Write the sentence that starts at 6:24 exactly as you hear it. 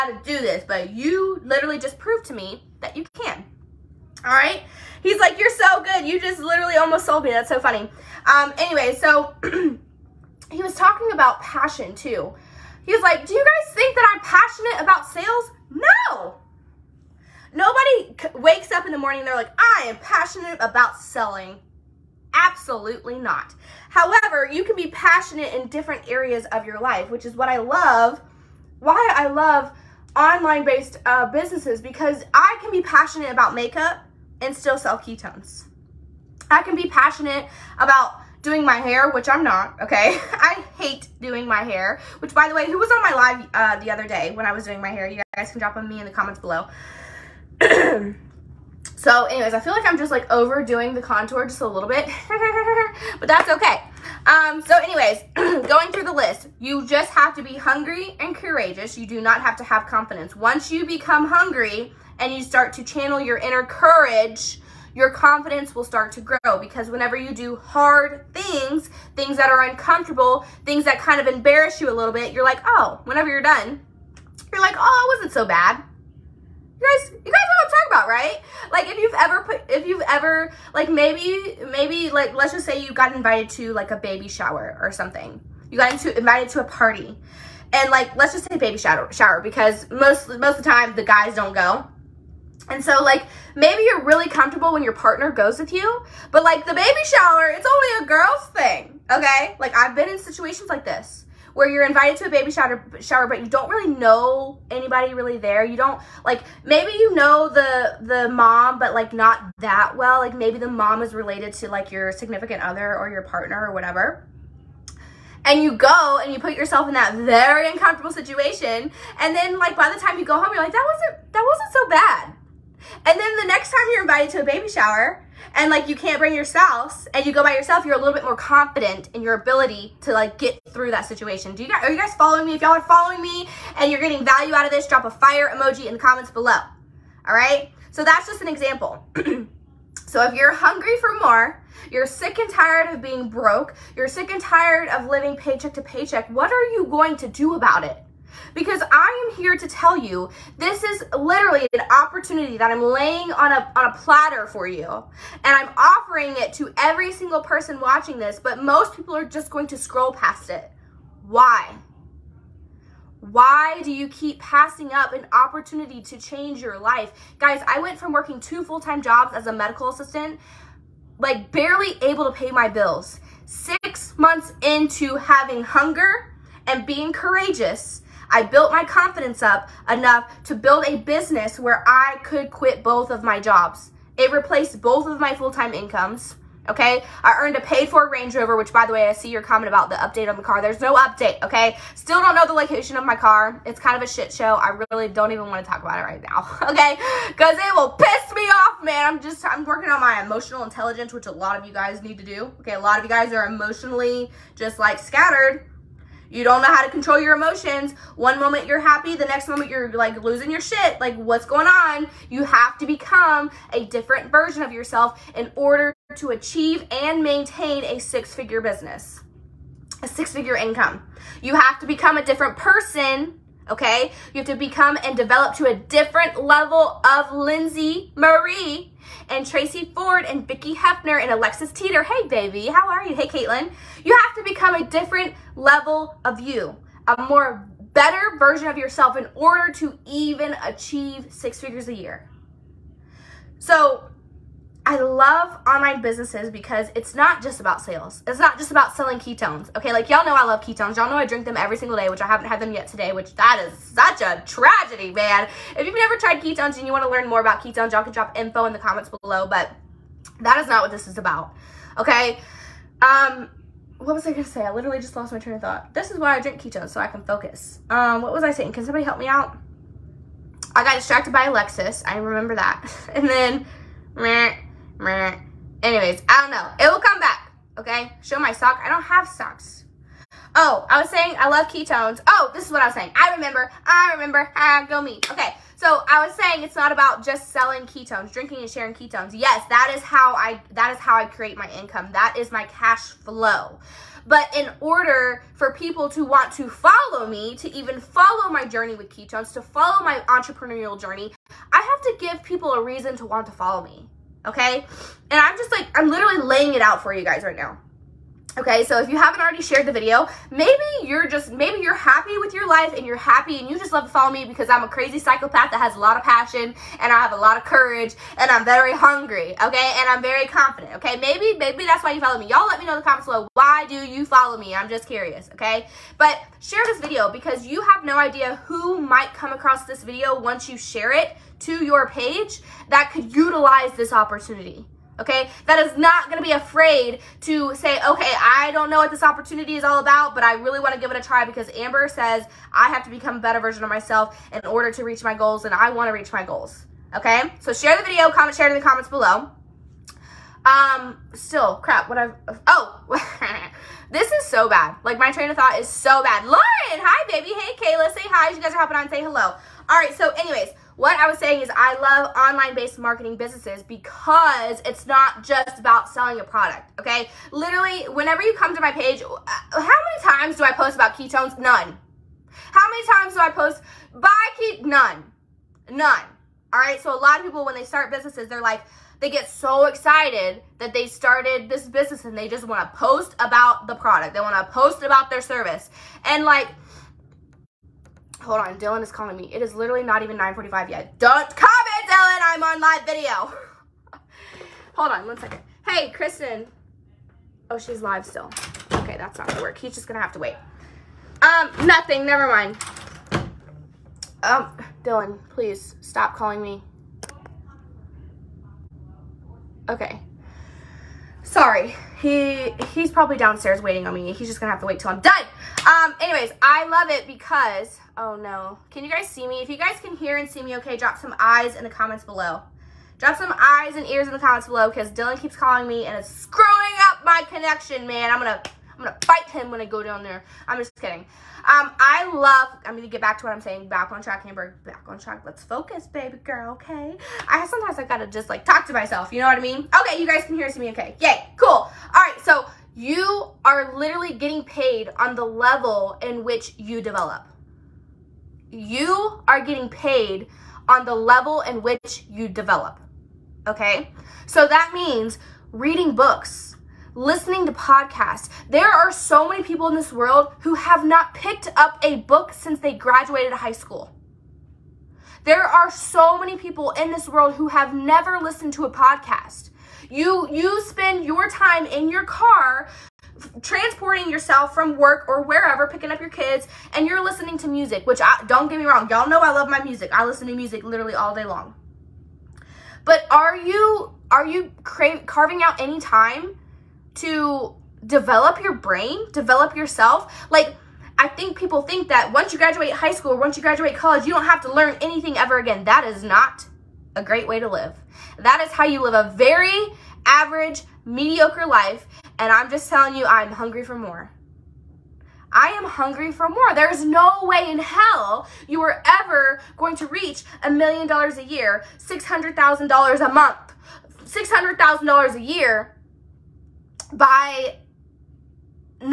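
They want to post about their service.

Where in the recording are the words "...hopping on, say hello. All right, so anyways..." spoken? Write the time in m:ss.
5:58.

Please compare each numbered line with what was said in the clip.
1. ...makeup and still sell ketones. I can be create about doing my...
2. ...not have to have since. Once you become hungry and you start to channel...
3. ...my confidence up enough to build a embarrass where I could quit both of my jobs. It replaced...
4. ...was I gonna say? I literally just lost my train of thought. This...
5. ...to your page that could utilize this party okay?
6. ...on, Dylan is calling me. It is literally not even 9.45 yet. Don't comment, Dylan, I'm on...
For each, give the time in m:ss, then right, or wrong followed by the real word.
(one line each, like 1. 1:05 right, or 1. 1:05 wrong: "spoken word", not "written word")
1. 0:33 wrong: "passionate", not "create"
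2. 0:59 wrong: "confidence", not "since"
3. 2:58 wrong: "business", not "embarrass"
4. 4:24 right
5. 5:31 wrong: "opportunity", not "party"
6. 6:28 right.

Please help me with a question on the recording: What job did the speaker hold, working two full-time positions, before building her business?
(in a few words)
Medical assistant.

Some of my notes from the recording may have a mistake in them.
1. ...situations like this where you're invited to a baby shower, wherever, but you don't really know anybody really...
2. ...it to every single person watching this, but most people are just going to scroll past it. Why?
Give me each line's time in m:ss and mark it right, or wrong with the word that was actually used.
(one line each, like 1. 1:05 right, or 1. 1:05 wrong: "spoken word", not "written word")
1. 1:40 wrong: "shower", not "wherever"
2. 2:36 right.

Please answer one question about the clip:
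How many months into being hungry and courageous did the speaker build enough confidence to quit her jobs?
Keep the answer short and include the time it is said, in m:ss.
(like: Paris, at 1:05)
6 months, at 2:53.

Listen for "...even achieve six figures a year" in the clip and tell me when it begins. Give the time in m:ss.
4:00.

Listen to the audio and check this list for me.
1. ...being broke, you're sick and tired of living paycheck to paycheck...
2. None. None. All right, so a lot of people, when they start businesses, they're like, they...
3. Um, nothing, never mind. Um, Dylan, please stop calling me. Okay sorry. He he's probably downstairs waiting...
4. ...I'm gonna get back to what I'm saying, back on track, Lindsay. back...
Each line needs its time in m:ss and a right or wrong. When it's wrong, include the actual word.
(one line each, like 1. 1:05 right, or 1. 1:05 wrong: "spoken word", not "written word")
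1. 2:23 right
2. 6:14 right
3. 6:41 right
4. 7:12 wrong: "Amber", not "Lindsay".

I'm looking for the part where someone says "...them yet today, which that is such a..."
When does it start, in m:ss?
4:12.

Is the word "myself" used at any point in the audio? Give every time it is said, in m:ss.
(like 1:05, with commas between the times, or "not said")
5:43, 7:18.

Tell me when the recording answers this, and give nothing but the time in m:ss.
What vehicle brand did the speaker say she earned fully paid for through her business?
3:08.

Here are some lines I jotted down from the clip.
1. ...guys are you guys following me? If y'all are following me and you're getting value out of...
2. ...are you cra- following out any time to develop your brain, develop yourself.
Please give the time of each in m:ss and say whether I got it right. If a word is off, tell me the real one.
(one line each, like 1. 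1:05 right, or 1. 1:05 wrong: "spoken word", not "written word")
1. 2:11 right
2. 8:04 wrong: "carving", not "following".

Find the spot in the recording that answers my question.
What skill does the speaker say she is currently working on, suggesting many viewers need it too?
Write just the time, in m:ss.
3:20.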